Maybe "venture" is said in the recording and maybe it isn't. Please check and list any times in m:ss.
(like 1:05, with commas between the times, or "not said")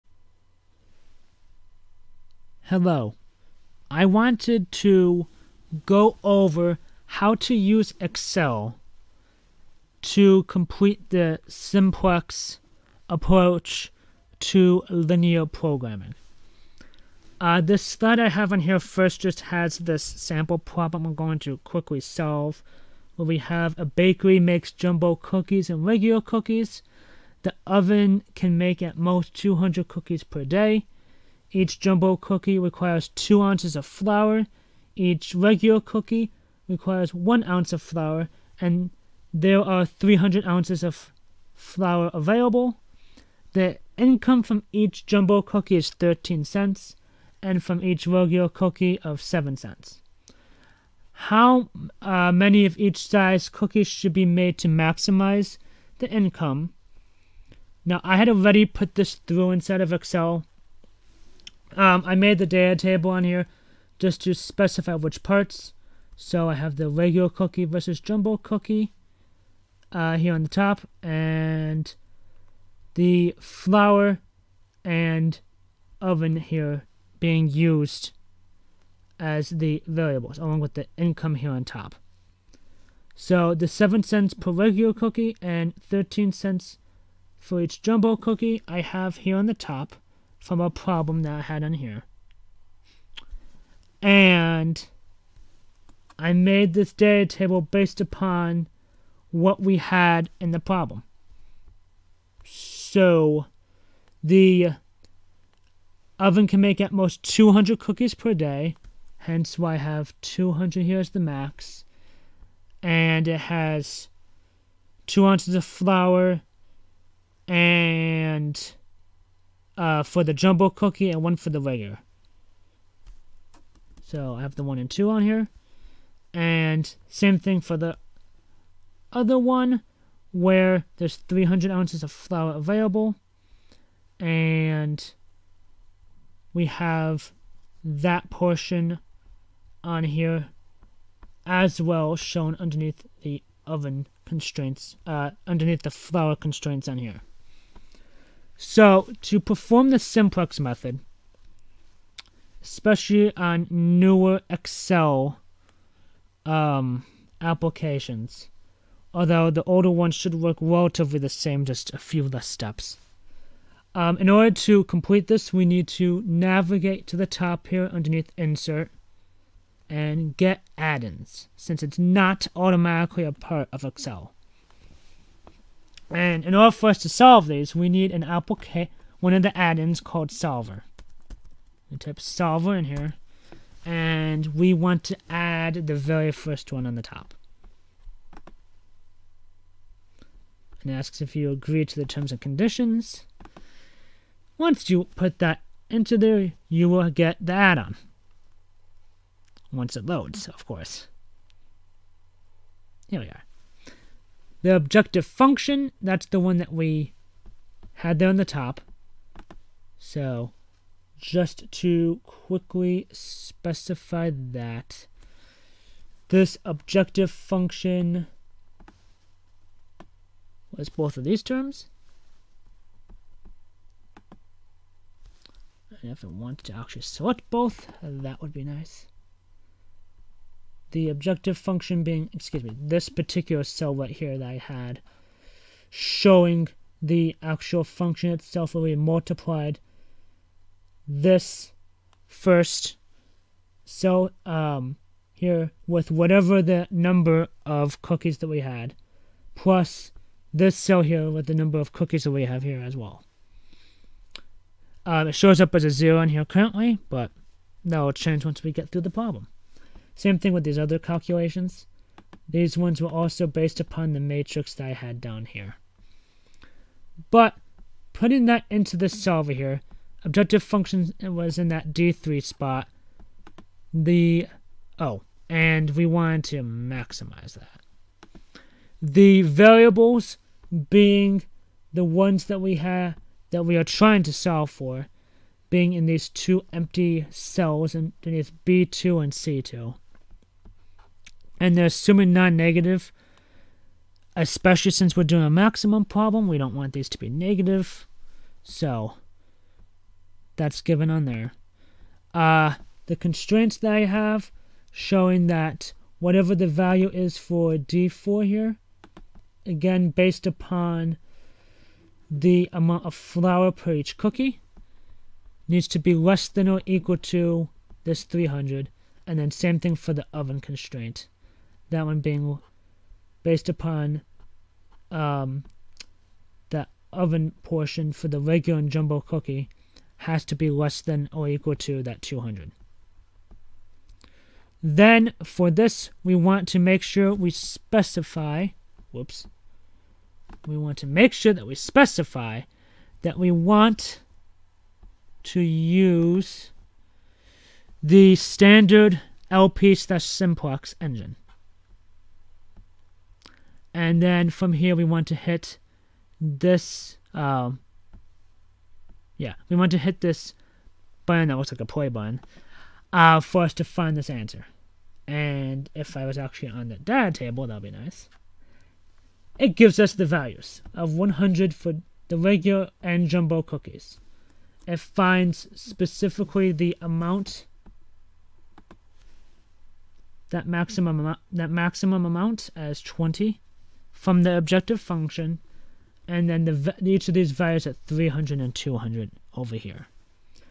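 not said.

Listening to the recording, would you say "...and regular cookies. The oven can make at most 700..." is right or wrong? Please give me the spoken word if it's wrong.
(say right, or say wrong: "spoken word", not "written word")
wrong: "200", not "700".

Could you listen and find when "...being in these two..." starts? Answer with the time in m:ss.
4:45.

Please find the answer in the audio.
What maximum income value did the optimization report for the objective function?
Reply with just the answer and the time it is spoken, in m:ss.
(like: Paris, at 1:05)
20, at 6:23.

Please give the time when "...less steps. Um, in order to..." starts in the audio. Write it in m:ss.
2:42.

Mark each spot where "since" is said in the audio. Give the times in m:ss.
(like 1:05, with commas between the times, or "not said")
2:51, 4:54.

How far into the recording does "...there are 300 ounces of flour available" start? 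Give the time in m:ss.
0:39.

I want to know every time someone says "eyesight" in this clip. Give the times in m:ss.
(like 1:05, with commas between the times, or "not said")
not said.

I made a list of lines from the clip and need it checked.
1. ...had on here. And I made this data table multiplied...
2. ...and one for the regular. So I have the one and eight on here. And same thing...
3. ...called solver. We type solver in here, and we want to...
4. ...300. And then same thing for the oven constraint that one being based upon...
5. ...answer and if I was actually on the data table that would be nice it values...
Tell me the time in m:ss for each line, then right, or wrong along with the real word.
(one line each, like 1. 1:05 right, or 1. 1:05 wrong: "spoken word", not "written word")
1. 1:31 wrong: "based", not "multiplied"
2. 2:01 wrong: "two", not "eight"
3. 3:00 right
4. 5:18 right
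5. 6:04 wrong: "gives", not "values".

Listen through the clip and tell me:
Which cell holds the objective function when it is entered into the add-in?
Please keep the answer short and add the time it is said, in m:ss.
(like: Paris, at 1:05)
D3, at 4:31.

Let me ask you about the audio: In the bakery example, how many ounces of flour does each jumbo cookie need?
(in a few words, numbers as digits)
2 ounces.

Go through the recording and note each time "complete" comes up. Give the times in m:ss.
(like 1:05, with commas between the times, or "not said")
0:10, 2:44.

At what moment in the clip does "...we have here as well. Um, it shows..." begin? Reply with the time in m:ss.
4:12.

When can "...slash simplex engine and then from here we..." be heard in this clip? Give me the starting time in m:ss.
5:49.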